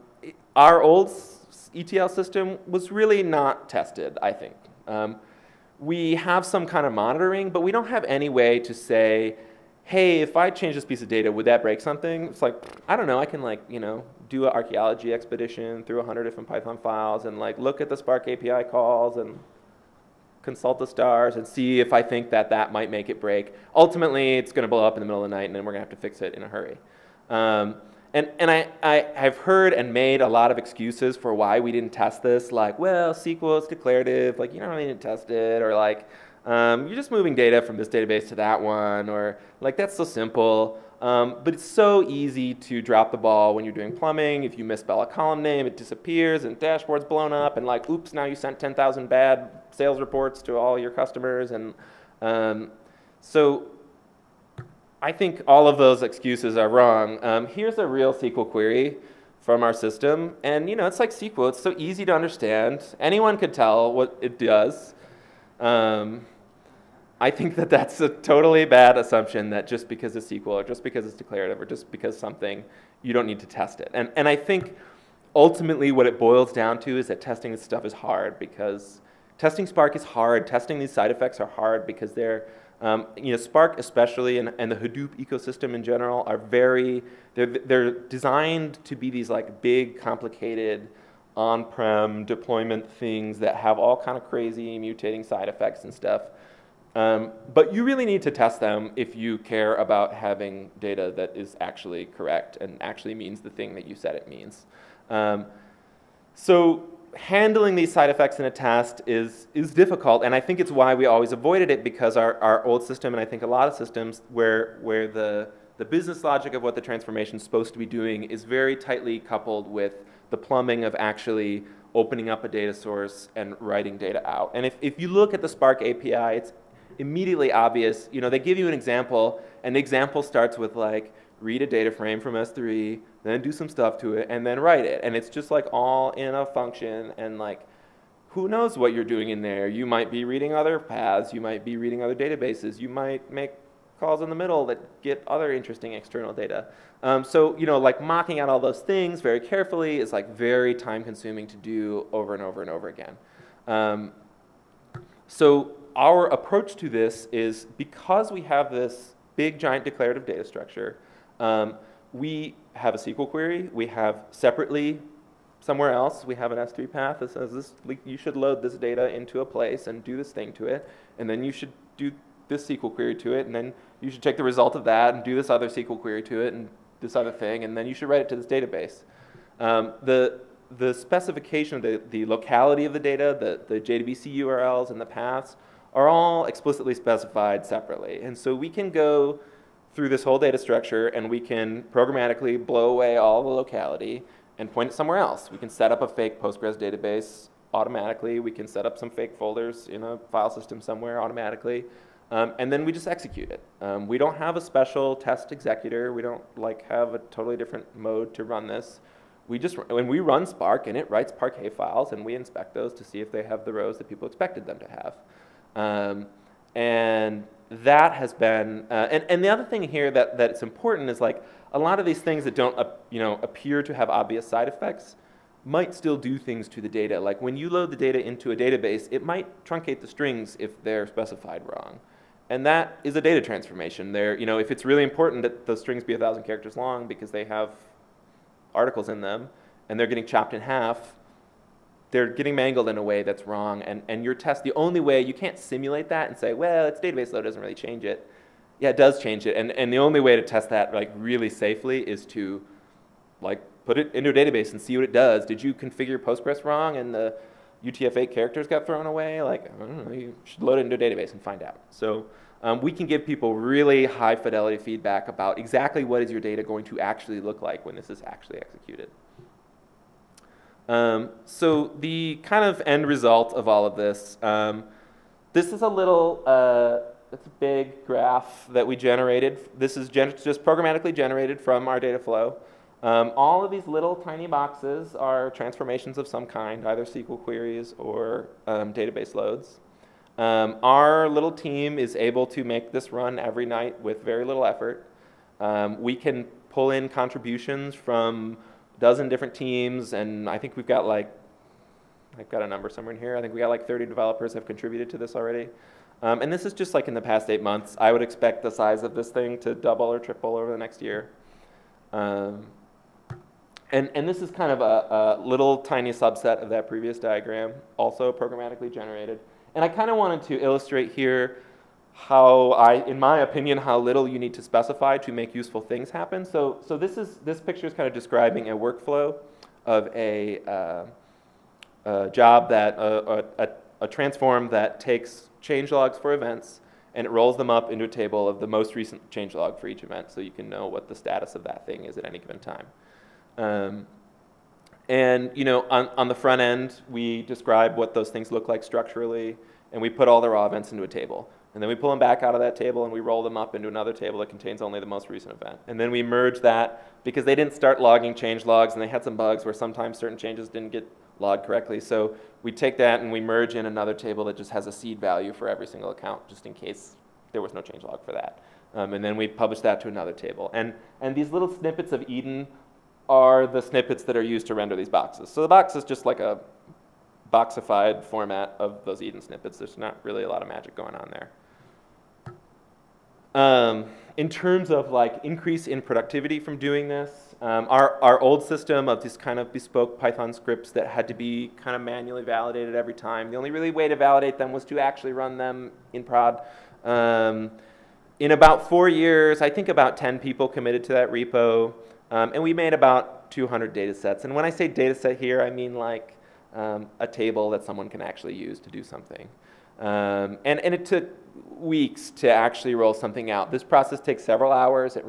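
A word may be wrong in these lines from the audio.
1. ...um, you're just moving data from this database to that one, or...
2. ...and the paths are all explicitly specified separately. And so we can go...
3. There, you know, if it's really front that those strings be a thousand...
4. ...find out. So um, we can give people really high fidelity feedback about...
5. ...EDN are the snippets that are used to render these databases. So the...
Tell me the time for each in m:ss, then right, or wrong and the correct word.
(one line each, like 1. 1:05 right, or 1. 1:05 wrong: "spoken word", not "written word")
1. 0:36 right
2. 3:04 right
3. 3:54 wrong: "important", not "front"
4. 4:21 right
5. 6:12 wrong: "boxes", not "databases".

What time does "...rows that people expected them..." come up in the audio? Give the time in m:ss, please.
3:33.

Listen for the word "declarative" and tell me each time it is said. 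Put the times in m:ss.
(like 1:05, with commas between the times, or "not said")
0:33, 1:11, 2:39.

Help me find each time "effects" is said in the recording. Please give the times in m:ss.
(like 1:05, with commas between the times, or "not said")
1:21, 1:35, 1:48, 3:44.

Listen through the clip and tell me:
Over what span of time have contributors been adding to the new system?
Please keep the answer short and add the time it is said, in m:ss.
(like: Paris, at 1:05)
eight months, at 5:07.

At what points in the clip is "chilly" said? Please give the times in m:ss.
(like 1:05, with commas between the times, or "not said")
not said.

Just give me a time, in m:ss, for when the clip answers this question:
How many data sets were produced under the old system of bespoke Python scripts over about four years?
6:43.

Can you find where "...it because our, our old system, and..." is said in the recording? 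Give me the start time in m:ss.
1:51.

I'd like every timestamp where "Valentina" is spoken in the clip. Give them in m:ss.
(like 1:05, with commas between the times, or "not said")
not said.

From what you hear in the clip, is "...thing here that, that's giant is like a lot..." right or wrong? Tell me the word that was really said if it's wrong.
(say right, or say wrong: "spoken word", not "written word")
wrong: "important", not "giant".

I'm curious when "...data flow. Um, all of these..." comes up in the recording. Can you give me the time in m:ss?
4:41.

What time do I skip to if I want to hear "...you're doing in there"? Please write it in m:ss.
2:18.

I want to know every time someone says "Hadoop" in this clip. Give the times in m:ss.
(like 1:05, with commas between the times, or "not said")
1:24.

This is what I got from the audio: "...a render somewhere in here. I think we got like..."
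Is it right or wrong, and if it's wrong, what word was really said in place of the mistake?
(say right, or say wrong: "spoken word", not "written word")
wrong: "number", not "render".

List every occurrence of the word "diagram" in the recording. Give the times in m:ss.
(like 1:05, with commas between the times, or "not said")
5:17.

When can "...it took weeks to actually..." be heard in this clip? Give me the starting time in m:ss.
6:50.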